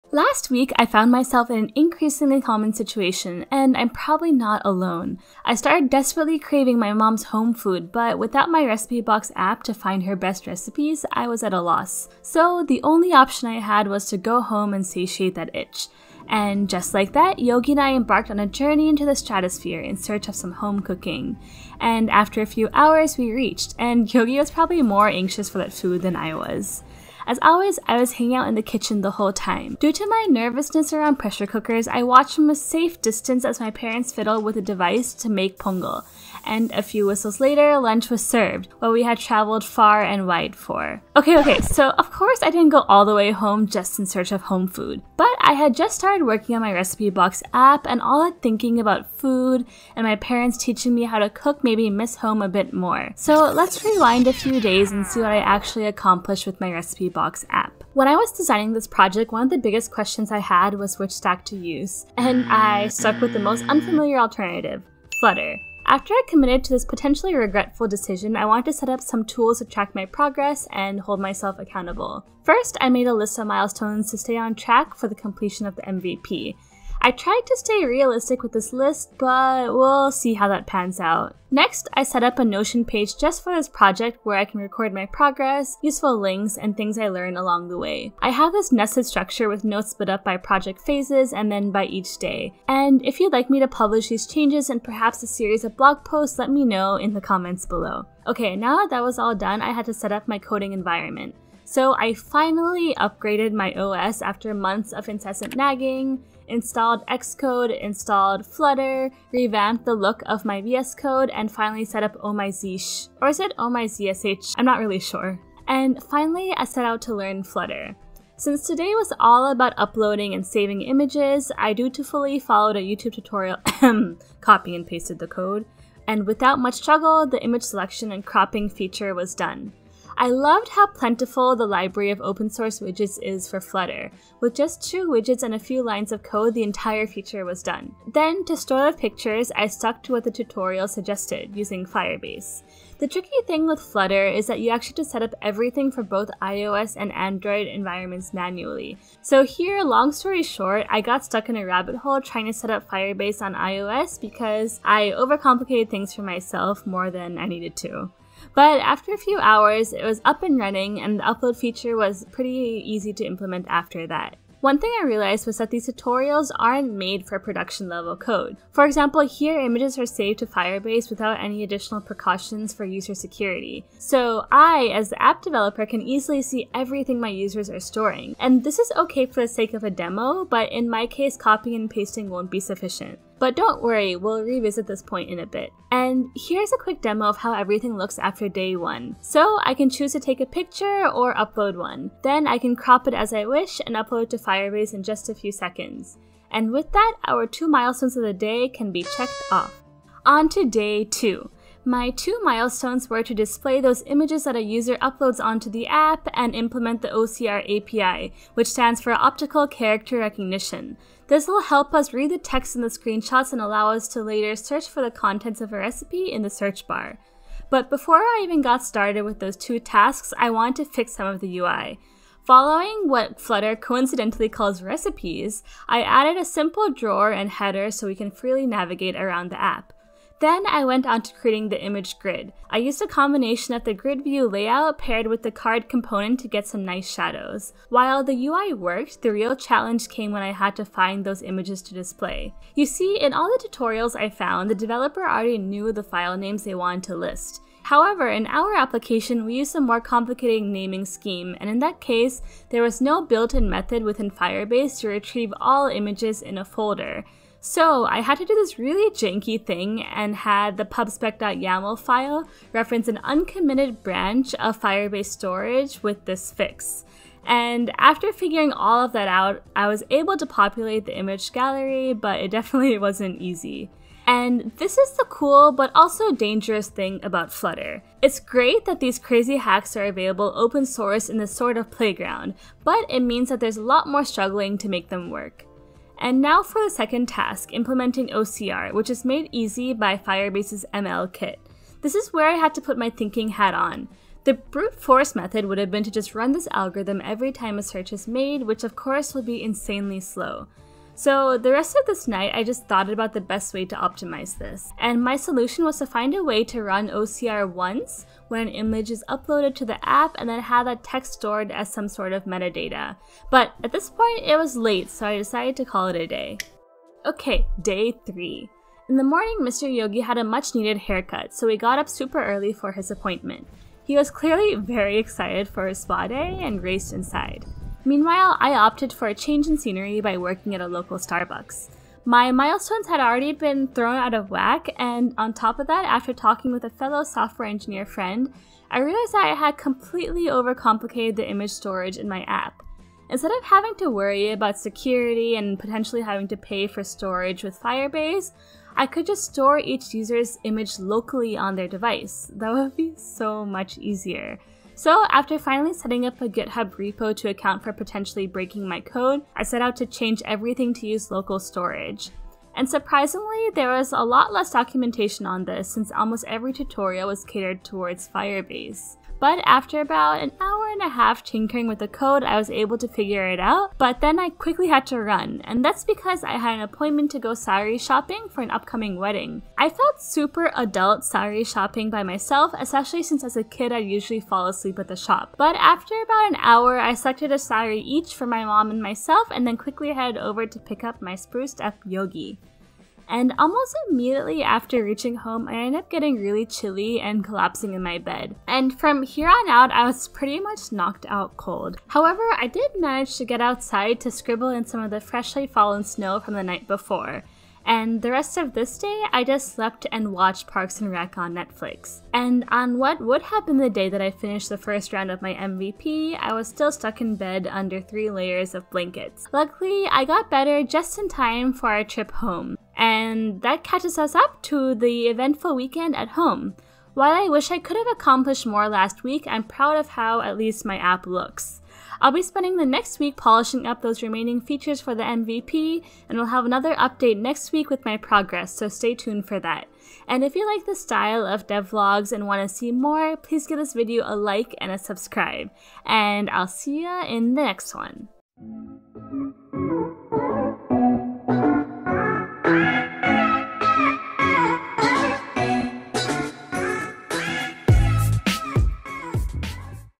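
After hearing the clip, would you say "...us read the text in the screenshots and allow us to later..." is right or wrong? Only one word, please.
right.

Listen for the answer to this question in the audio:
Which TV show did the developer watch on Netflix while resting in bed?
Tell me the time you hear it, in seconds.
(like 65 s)
410 s.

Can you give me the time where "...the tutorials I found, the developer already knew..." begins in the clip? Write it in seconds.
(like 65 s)
243 s.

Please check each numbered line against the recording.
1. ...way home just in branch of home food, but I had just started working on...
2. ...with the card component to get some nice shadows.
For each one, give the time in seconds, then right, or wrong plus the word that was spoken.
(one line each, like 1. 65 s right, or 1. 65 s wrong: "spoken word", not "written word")
1. 43 s wrong: "search", not "branch"
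2. 235 s right.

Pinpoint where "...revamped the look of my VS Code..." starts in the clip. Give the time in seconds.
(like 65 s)
109 s.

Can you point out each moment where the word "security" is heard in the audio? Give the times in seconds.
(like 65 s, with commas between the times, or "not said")
173 s, 344 s.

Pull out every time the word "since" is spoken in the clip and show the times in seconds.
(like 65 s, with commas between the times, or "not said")
118 s, 365 s, 383 s.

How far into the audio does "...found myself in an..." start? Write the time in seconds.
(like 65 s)
0 s.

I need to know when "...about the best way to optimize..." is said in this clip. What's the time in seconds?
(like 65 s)
303 s.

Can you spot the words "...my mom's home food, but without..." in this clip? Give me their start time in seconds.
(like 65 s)
6 s.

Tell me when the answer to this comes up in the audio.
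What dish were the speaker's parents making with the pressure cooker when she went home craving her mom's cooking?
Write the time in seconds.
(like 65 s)
35 s.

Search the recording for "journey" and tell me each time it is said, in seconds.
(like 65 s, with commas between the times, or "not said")
18 s.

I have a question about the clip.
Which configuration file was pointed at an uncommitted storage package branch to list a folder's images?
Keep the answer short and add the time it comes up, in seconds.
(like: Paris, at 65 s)
pubspec.yaml, at 260 s.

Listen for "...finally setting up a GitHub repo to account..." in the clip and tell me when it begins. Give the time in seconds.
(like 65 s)
355 s.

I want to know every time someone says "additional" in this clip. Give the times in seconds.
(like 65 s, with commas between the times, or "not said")
171 s.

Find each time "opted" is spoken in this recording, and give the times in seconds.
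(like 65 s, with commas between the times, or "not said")
328 s.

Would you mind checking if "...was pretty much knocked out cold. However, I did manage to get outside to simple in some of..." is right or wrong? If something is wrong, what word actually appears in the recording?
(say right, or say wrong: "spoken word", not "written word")
wrong: "scribble", not "simple".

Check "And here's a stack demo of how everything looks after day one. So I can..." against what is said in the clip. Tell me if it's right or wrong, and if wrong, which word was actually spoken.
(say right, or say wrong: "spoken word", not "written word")
wrong: "quick", not "stack".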